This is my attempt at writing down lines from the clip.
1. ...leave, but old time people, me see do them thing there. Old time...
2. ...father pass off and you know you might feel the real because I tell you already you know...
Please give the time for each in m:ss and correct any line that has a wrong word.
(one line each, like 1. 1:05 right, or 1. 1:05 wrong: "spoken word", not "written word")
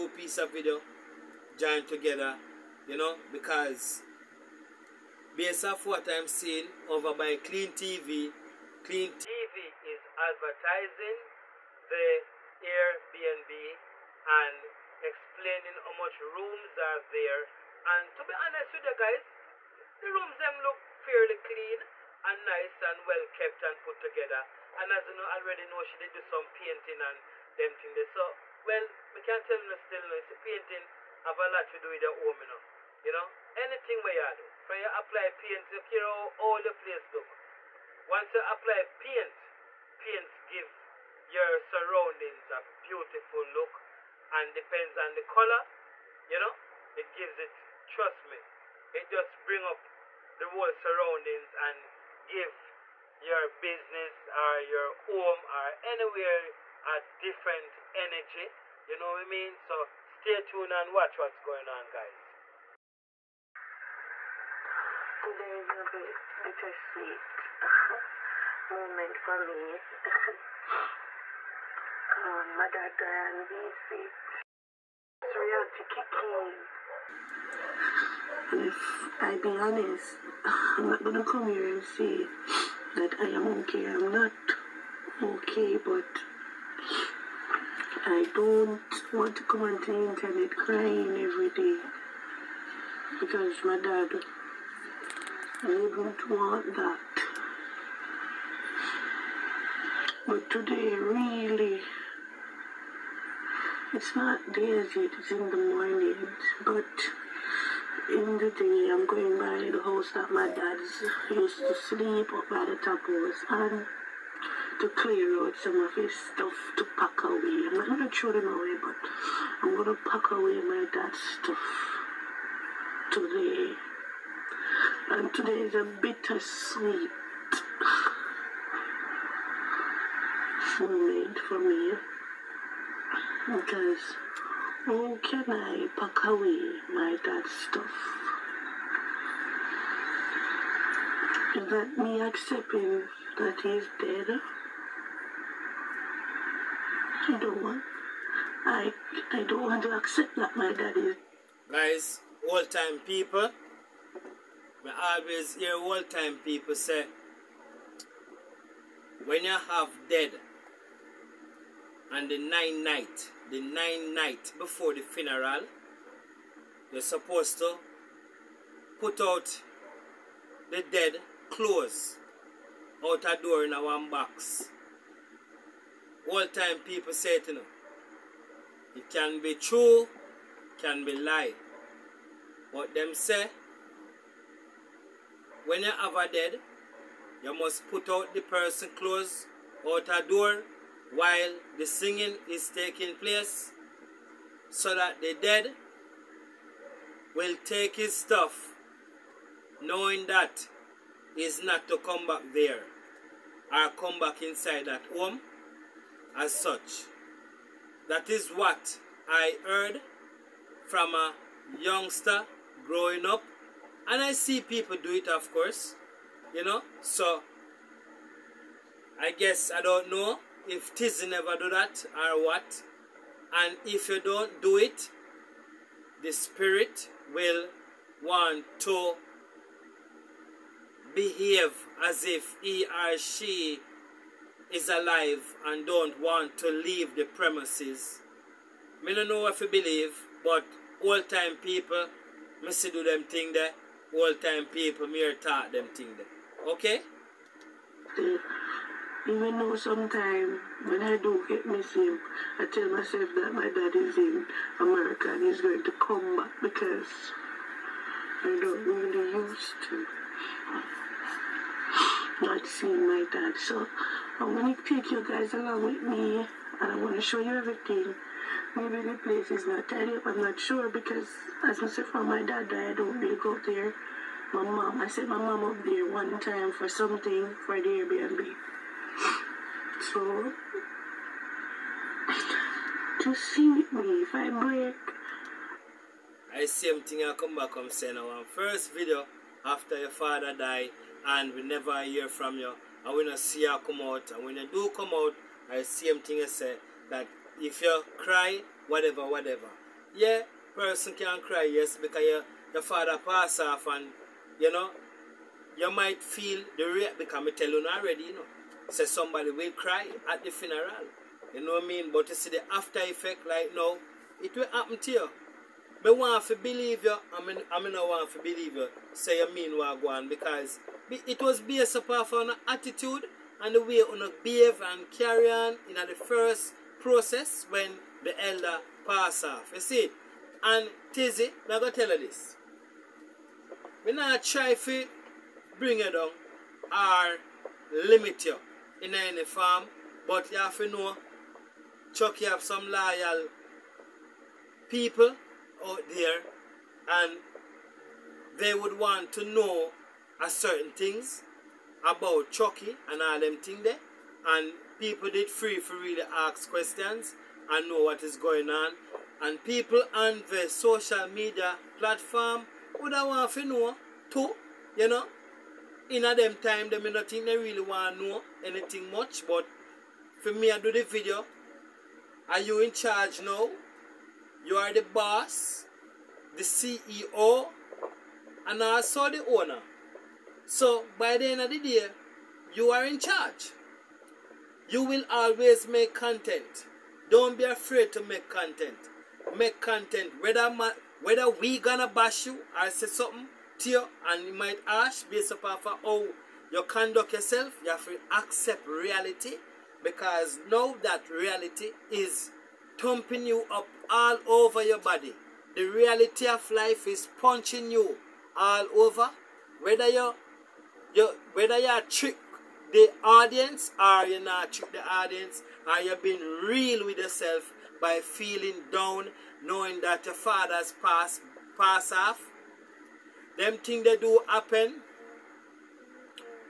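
1. 3:59 wrong: "believe", not "leave"
2. 5:02 right.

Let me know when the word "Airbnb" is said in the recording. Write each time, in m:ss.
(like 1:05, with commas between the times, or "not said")
0:12, 4:37.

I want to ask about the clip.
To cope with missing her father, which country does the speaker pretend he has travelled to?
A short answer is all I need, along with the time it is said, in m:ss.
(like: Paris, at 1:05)
America, at 4:14.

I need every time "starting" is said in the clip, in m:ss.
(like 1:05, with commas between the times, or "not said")
not said.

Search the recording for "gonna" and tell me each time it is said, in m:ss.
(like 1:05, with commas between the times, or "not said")
1:21, 6:31.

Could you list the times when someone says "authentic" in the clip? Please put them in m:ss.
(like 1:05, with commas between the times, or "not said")
not said.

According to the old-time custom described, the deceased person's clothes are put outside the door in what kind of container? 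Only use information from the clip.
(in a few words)
one box.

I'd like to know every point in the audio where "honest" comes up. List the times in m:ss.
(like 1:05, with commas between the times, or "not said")
0:18, 1:19.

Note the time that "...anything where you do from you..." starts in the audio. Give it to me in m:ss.
0:33.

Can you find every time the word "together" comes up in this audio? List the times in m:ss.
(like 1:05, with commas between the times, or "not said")
0:01, 0:24.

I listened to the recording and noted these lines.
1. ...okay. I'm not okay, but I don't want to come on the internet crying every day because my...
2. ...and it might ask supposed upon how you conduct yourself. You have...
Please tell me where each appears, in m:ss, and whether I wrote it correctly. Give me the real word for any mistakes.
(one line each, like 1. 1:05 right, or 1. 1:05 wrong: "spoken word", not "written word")
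1. 1:23 right
2. 6:34 wrong: "based", not "supposed".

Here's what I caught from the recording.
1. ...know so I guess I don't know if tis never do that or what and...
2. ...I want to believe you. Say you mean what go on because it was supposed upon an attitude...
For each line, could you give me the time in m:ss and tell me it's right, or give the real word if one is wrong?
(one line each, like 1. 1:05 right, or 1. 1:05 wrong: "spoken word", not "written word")
1. 3:36 right
2. 5:17 wrong: "based", not "supposed".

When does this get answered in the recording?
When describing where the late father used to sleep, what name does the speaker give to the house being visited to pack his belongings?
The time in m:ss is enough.
1:52.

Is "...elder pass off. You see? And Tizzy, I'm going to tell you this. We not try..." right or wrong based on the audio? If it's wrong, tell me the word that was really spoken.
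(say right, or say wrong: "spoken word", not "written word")
right.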